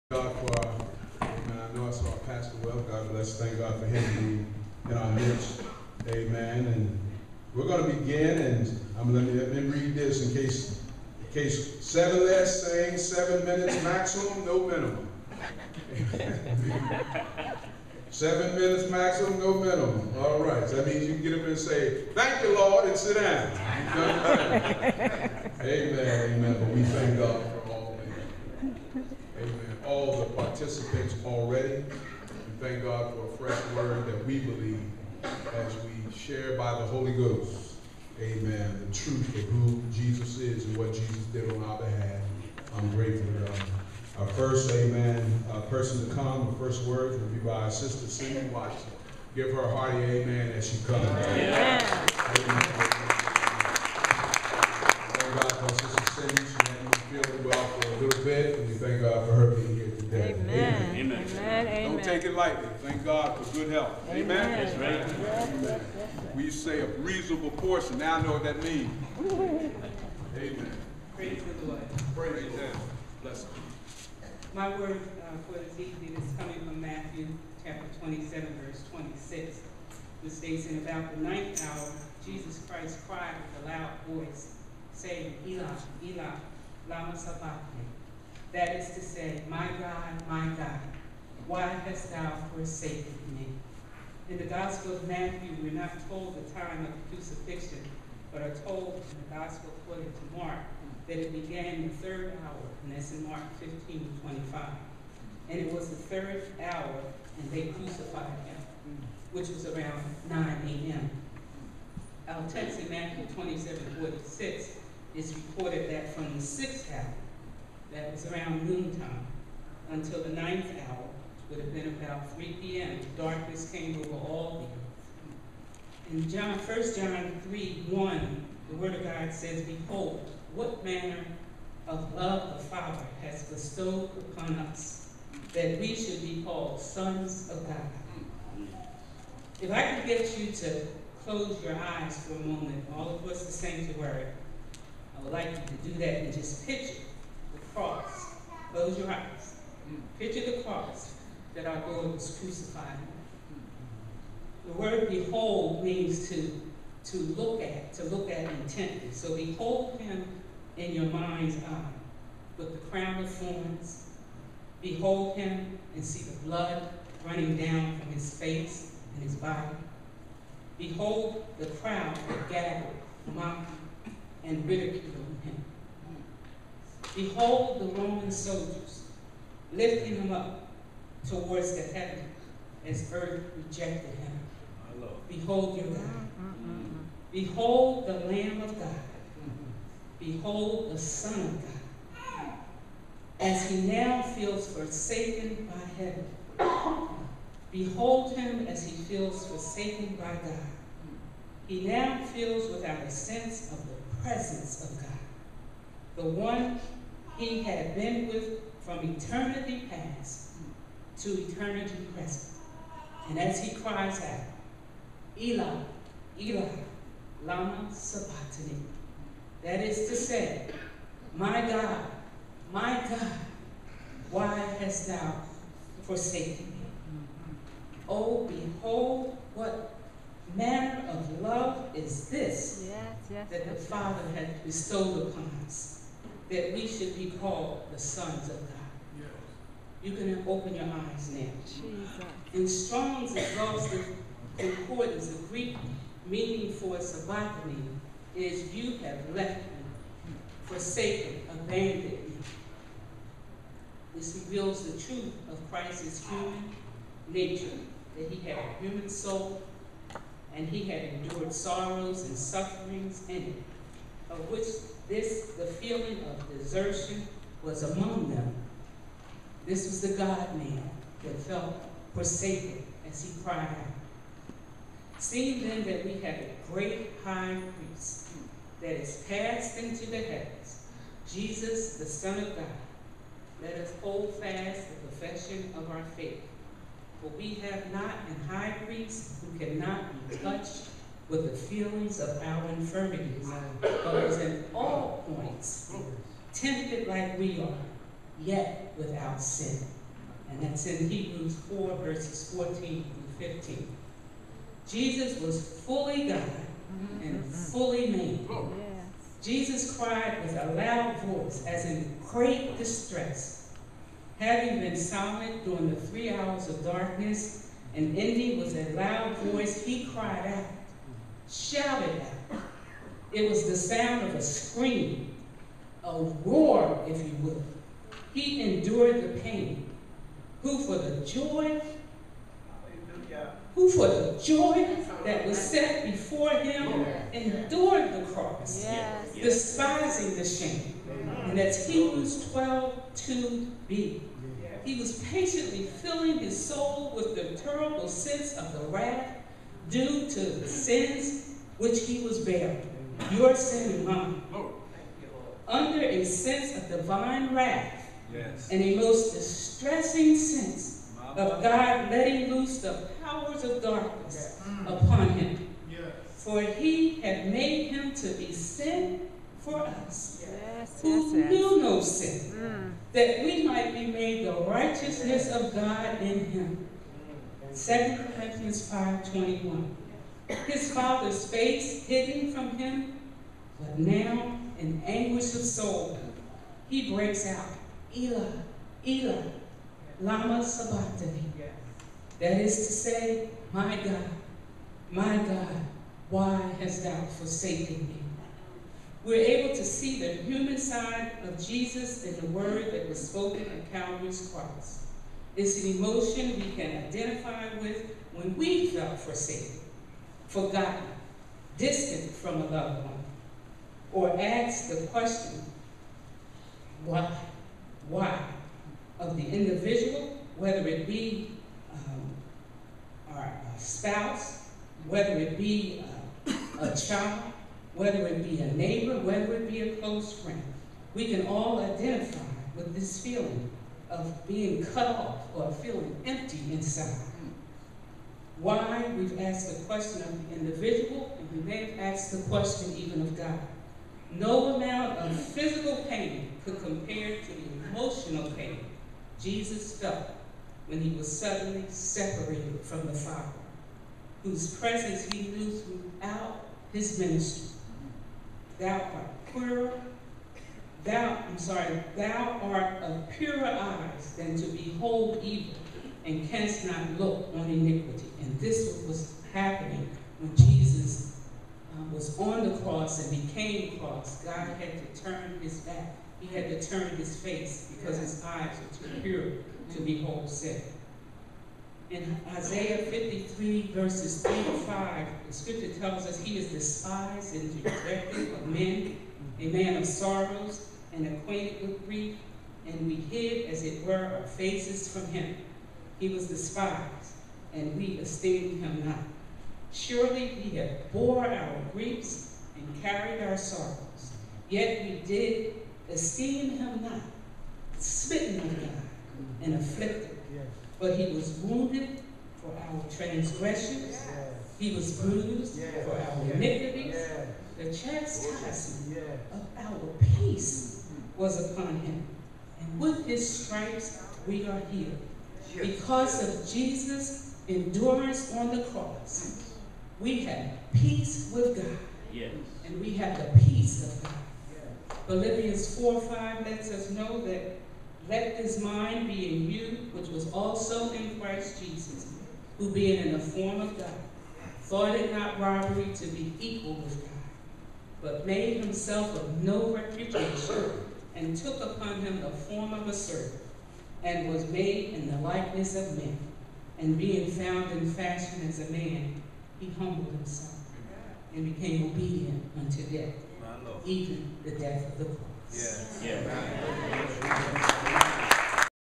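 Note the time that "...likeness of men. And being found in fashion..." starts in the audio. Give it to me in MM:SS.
09:15.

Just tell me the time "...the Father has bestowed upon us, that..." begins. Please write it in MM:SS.
02:12.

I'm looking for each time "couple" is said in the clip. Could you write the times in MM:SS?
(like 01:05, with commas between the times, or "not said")
not said.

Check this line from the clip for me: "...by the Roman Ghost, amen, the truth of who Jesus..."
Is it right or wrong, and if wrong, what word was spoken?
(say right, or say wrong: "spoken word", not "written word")
wrong: "Holy", not "Roman".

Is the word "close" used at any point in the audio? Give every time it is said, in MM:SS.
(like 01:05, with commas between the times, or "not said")
02:21, 02:28, 07:09.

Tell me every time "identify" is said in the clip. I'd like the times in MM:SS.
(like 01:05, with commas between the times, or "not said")
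06:47, 07:11.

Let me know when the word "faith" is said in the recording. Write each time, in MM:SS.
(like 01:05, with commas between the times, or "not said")
04:46.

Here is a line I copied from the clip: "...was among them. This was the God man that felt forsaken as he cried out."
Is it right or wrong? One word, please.
right.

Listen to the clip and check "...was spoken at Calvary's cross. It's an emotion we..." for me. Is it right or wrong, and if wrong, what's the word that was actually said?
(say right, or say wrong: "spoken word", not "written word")
right.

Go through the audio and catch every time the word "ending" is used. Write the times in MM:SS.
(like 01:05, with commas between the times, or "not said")
05:18.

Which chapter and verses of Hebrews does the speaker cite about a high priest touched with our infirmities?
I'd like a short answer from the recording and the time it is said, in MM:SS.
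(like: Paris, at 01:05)
Hebrews 4:14-15, at 05:01.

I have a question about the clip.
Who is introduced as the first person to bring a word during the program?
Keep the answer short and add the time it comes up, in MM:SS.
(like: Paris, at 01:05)
Cindy Watson, at 00:48.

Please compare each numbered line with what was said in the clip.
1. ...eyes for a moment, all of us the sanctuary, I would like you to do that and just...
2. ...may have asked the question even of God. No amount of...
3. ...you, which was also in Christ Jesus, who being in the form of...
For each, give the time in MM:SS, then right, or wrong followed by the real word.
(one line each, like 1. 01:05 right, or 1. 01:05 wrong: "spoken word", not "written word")
1. 02:21 right
2. 07:21 right
3. 08:59 right.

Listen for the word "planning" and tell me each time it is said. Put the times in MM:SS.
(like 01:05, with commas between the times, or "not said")
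not said.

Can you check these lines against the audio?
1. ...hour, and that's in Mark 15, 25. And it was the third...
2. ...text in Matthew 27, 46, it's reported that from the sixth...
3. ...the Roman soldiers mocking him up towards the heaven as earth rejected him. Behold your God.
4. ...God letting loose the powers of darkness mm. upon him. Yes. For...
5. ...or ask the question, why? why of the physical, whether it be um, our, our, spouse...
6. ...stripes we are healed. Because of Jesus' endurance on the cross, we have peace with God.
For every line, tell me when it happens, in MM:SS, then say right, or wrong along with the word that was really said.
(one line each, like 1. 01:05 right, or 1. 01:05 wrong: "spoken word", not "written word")
1. 01:42 right
2. 01:52 right
3. 02:57 wrong: "lifting", not "mocking"
4. 06:01 right
5. 06:54 wrong: "individual", not "physical"
6. 08:43 right.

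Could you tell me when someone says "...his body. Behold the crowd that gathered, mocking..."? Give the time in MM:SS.
02:49.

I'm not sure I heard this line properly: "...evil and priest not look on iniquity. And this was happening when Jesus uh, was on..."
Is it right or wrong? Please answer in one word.
wrong.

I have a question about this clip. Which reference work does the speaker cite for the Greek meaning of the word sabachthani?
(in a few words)
Strong's exhaustive concordance.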